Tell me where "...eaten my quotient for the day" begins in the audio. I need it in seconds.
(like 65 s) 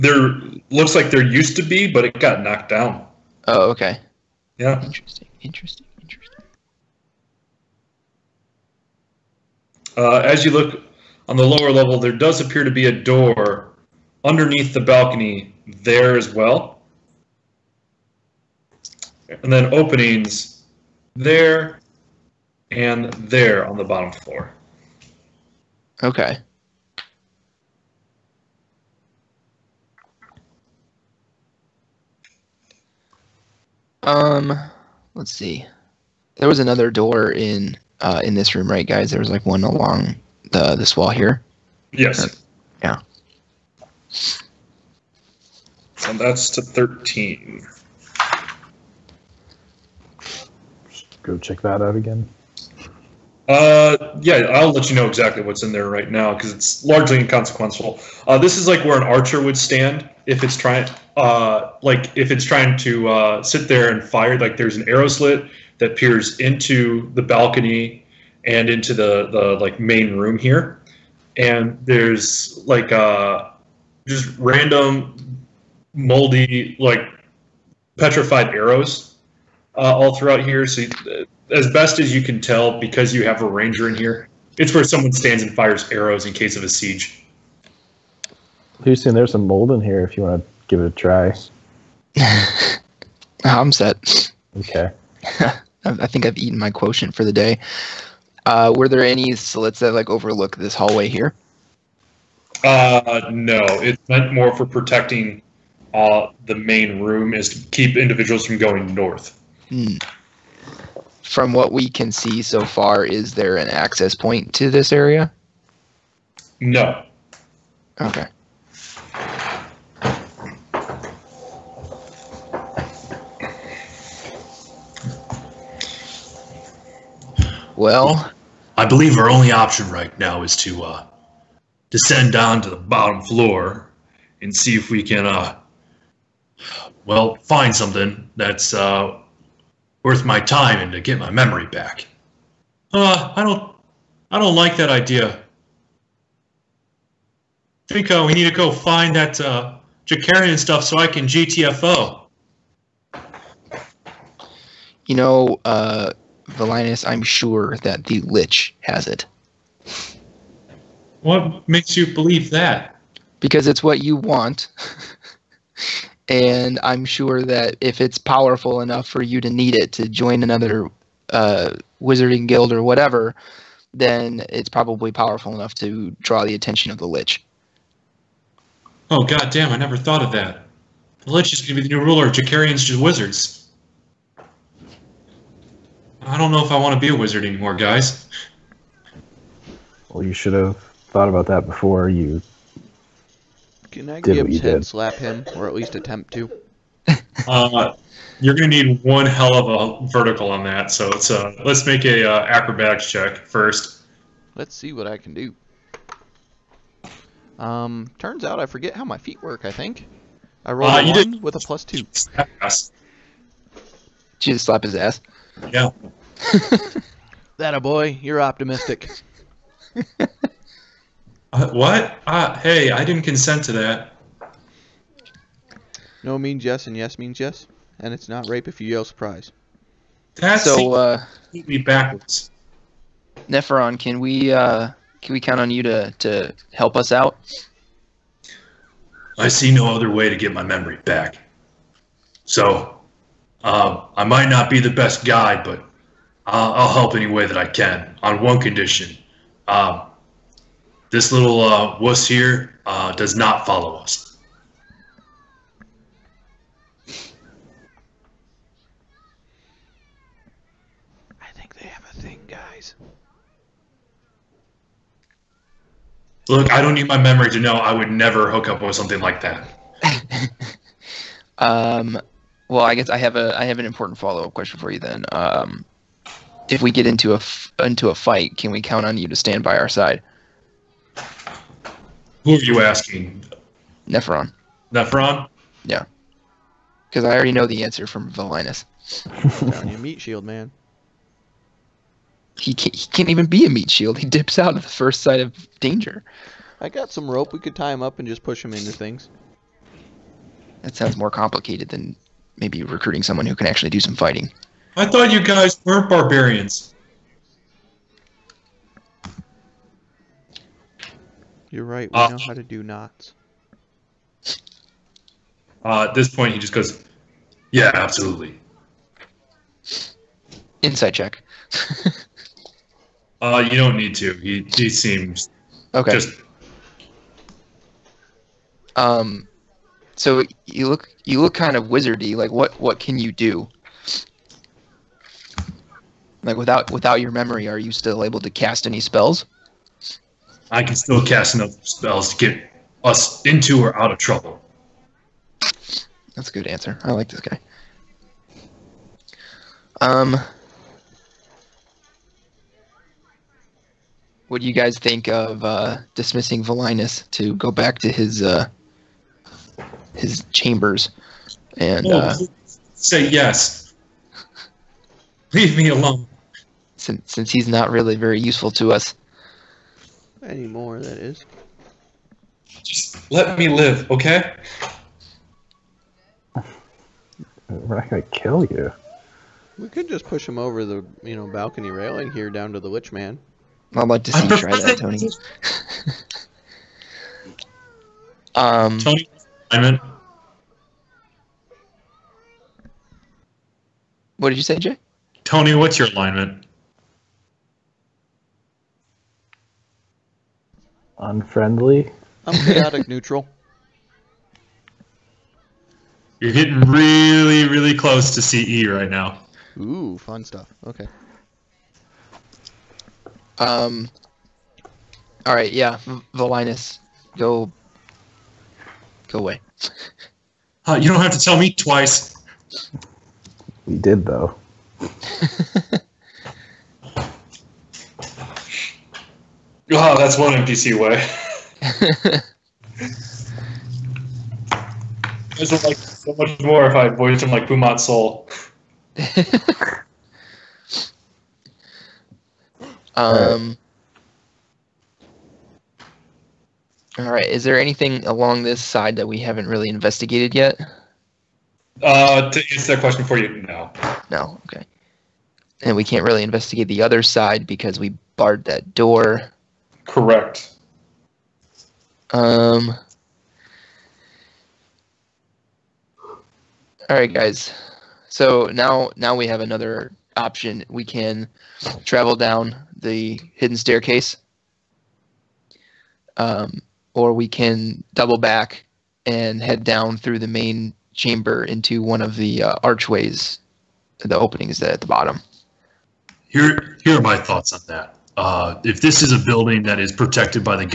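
96 s.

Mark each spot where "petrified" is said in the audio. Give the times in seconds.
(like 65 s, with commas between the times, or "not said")
77 s.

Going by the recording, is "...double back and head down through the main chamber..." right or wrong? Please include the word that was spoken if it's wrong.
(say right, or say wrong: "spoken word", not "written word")
right.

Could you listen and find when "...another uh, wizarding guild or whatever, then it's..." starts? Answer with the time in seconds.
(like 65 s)
170 s.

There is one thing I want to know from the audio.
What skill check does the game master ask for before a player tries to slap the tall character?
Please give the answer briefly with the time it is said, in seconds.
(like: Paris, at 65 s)
Acrobatics, at 202 s.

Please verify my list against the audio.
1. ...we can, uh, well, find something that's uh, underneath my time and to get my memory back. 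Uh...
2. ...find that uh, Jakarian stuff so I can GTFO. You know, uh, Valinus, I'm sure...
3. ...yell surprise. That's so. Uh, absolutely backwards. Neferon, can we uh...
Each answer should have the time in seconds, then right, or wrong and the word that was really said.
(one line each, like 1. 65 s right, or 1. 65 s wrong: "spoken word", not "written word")
1. 134 s wrong: "worth", not "underneath"
2. 148 s right
3. 228 s wrong: "completely", not "absolutely".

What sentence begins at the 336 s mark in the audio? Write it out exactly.
Like without without your memory, are you still able to cast any spells?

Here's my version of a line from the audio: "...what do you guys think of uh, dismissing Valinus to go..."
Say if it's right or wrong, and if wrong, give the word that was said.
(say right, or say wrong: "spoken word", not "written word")
right.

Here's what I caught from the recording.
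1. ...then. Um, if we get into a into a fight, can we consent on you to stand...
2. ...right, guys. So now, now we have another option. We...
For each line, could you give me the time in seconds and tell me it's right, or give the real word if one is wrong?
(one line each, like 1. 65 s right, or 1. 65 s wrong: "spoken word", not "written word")
1. 274 s wrong: "count", not "consent"
2. 467 s right.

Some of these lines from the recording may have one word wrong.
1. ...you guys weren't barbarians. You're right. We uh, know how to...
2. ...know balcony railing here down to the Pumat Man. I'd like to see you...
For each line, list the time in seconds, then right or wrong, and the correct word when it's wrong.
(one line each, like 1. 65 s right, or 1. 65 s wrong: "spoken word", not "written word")
1. 305 s right
2. 381 s wrong: "Lich", not "Pumat".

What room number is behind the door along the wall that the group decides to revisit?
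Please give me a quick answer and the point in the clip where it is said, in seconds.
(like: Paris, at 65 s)
13, at 46 s.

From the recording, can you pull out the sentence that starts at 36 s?
There was another door in uh, in this room, right, guys?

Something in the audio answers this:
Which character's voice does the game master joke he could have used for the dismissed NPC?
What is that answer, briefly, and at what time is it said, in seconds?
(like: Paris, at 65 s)
Pumat Sol, at 437 s.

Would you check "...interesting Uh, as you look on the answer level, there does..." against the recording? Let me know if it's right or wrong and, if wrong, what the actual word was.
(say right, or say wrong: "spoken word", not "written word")
wrong: "lower", not "answer".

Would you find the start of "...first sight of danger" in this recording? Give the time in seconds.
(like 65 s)
294 s.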